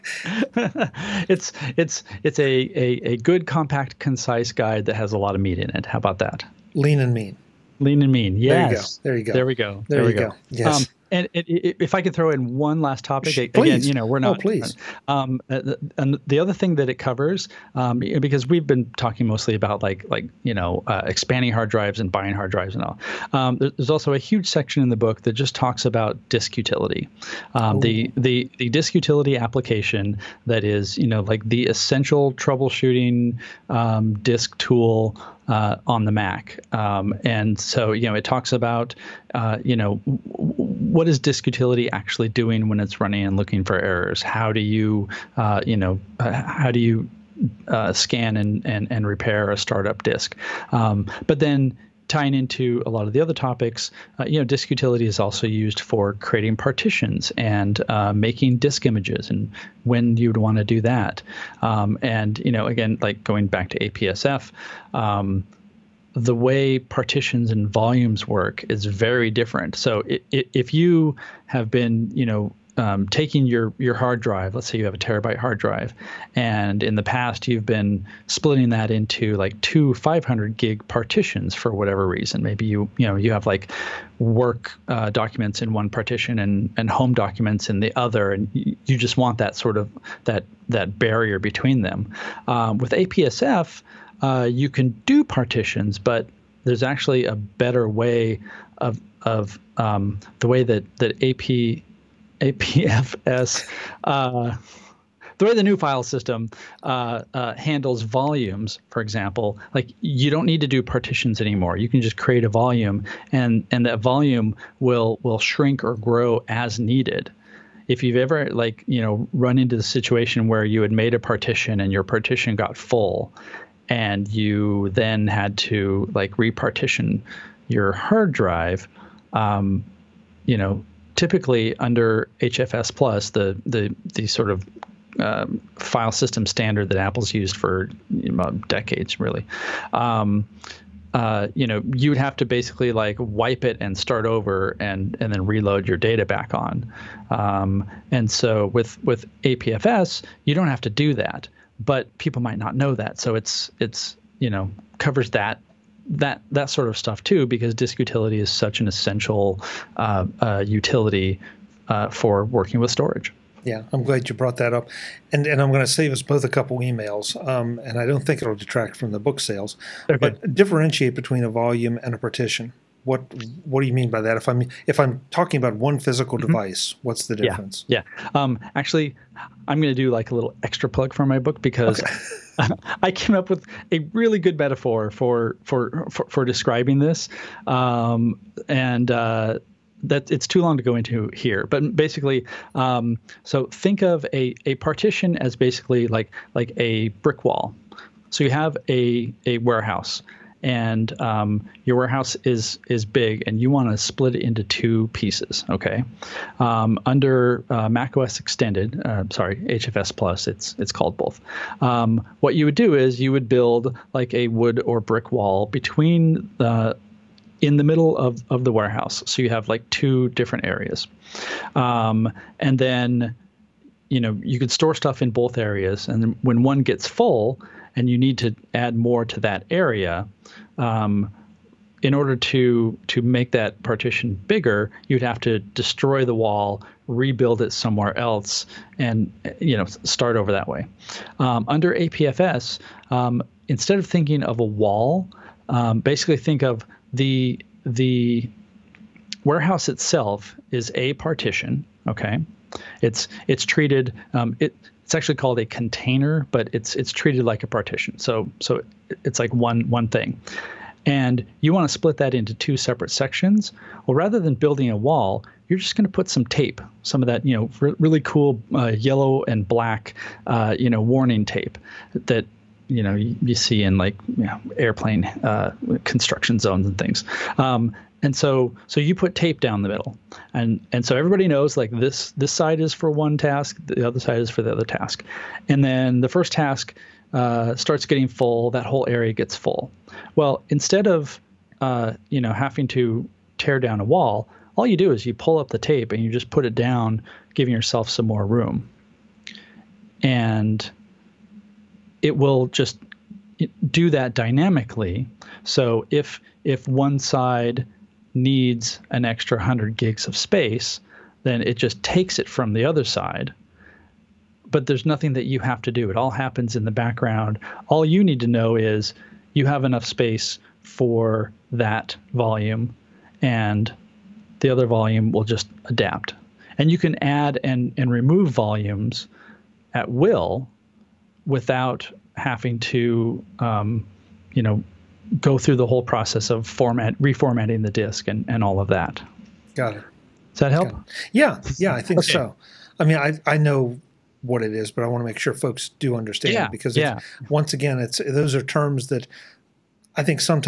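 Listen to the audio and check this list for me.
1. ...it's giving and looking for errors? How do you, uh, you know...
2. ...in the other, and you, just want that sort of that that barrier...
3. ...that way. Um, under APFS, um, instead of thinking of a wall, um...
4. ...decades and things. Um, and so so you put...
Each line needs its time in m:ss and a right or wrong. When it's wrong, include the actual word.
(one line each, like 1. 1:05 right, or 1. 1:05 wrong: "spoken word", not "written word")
1. 0:42 wrong: "running", not "giving"
2. 1:27 right
3. 4:00 right
4. 4:36 wrong: "zones", not "decades".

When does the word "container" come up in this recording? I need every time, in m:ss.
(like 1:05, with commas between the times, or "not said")
4:15.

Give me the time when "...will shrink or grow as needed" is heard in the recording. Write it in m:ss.
1:55.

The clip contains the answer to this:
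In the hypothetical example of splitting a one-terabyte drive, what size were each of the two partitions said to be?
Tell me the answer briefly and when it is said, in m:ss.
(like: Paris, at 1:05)
500 gig, at 1:19.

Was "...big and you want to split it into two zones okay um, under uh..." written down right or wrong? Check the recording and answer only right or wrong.
wrong.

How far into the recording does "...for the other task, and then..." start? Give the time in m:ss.
4:44.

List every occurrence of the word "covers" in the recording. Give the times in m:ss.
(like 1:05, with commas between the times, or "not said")
0:16, 2:34.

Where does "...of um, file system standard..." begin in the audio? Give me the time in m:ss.
2:14.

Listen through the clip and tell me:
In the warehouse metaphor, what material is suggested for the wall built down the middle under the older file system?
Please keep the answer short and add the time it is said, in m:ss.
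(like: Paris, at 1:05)
wood or brick, at 3:34.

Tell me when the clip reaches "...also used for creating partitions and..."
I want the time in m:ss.
0:55.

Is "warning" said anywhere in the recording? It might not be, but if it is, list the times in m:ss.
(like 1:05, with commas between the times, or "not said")
4:31.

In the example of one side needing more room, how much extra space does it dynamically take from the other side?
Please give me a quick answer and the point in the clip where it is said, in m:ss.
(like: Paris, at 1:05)
100 gigs, at 5:09.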